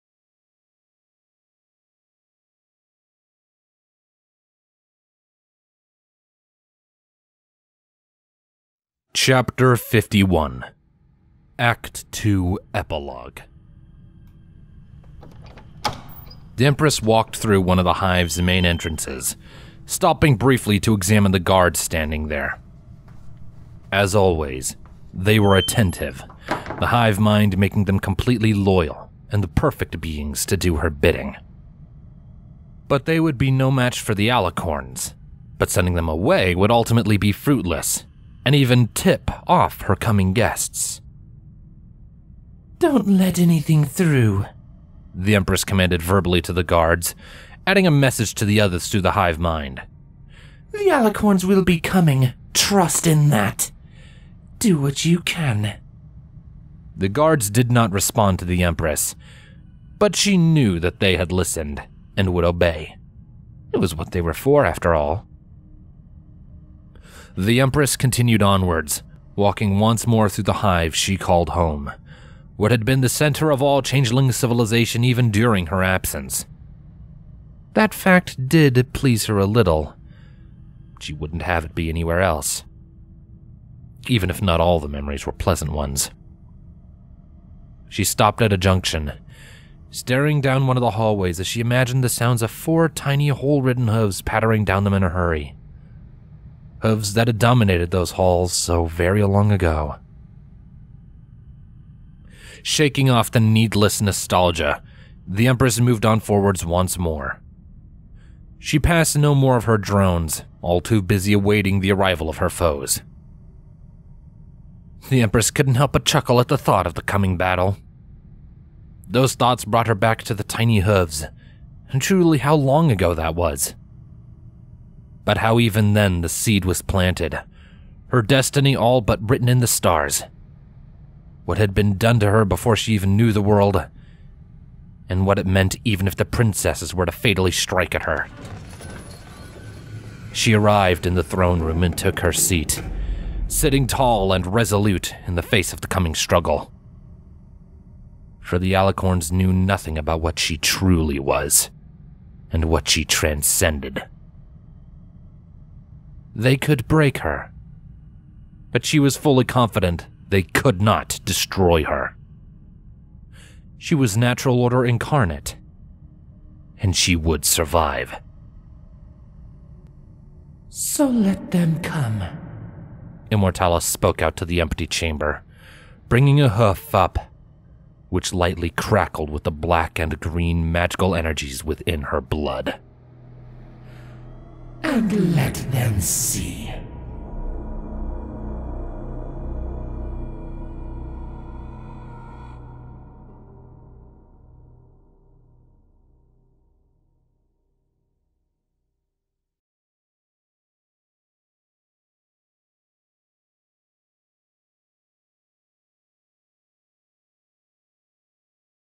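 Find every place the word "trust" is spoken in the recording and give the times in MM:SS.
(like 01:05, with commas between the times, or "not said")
00:52.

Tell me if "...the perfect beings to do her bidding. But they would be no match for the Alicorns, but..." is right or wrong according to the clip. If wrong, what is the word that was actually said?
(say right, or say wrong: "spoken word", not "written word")
right.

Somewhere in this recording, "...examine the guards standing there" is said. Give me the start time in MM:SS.
00:20.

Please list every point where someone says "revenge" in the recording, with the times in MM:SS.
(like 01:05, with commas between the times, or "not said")
not said.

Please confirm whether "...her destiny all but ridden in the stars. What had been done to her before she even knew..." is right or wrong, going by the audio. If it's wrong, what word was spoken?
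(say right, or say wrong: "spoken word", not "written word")
wrong: "written", not "ridden".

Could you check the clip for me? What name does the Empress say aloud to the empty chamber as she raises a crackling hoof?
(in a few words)
Immortalis.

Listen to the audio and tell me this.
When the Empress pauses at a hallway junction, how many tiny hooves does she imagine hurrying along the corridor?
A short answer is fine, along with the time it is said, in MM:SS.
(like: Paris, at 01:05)
4, at 01:32.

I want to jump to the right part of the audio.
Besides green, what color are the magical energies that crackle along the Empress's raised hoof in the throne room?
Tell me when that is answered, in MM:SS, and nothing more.
02:59.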